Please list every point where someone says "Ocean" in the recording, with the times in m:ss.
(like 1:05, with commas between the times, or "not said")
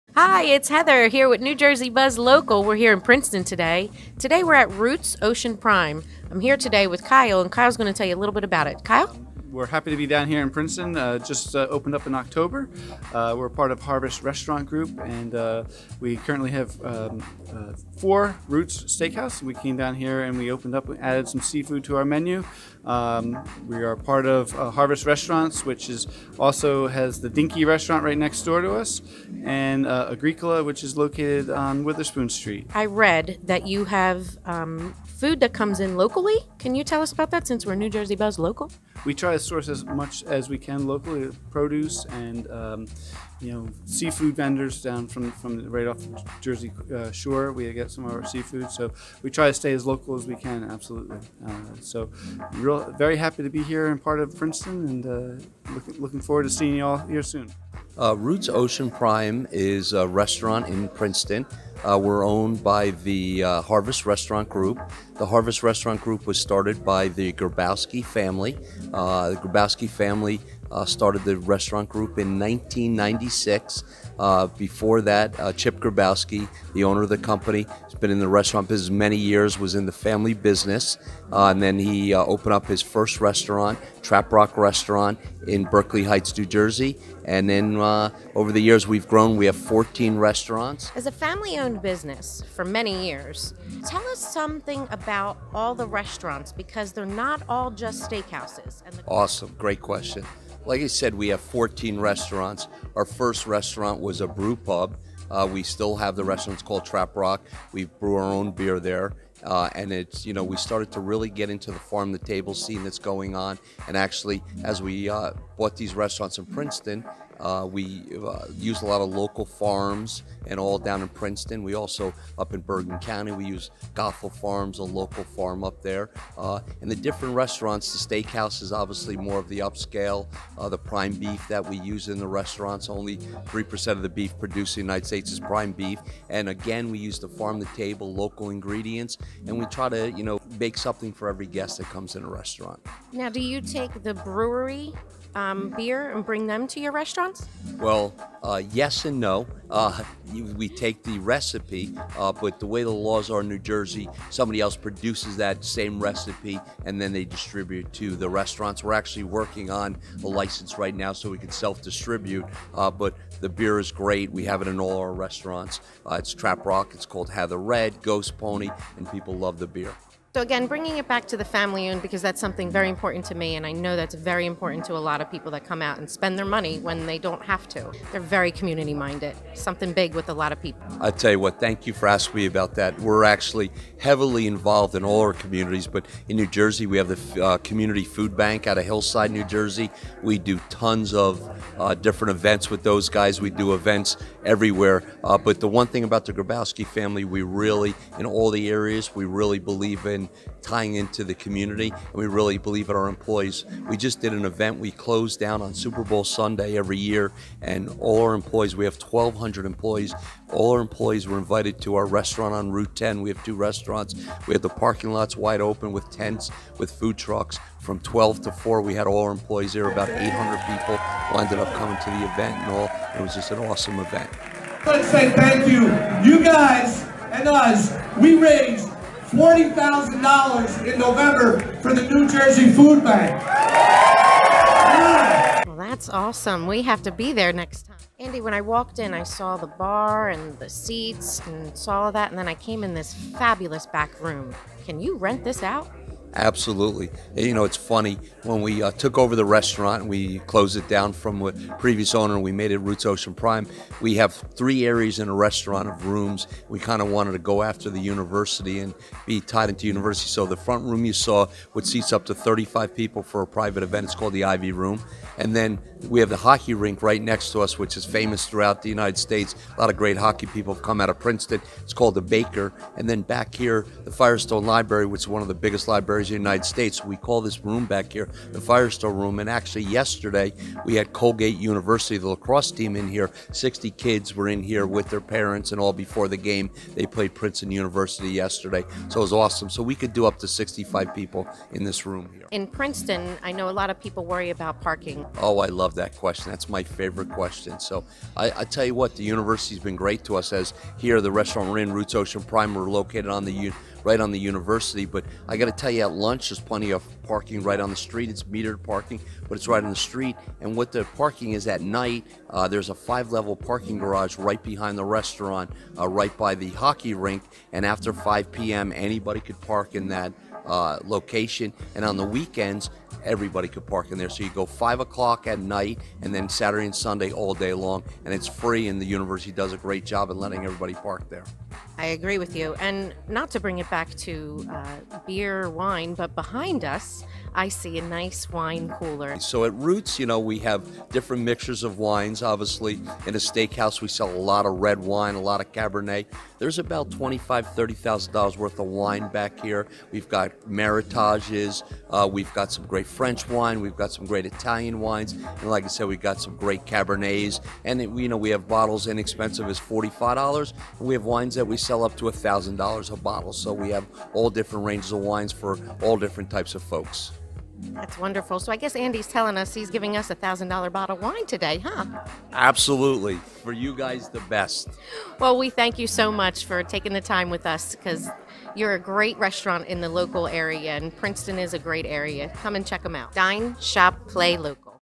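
0:05, 0:58, 4:13, 5:02.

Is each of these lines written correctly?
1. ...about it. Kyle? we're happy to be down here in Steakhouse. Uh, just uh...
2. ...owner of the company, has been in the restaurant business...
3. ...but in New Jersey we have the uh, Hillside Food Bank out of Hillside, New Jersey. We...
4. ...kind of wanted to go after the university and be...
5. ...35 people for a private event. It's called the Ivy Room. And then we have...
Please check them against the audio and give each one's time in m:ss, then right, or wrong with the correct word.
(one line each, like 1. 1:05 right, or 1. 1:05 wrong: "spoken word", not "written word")
1. 0:08 wrong: "Princeton", not "Steakhouse"
2. 1:16 right
3. 3:05 wrong: "Community", not "Hillside"
4. 4:16 right
5. 4:22 right.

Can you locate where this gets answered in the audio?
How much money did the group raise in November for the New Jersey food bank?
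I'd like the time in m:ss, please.
3:49.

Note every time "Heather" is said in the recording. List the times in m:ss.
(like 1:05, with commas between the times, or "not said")
0:00, 2:47.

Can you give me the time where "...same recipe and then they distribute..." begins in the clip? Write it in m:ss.
2:35.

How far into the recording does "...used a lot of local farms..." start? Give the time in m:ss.
1:58.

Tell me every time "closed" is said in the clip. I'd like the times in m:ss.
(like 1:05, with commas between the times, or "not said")
3:24, 4:10.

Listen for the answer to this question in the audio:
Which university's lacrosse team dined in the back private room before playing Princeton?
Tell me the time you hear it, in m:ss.
4:41.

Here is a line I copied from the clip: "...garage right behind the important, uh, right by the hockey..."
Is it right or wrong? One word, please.
wrong.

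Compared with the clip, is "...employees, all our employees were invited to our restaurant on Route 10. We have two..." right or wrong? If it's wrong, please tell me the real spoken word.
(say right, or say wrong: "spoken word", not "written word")
right.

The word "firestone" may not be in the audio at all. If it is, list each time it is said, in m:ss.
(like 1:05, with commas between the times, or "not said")
4:34, 4:38.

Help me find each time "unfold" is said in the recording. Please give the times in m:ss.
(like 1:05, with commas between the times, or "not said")
not said.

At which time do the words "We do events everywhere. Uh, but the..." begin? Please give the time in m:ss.
3:13.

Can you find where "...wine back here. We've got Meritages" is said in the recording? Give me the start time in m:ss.
5:48.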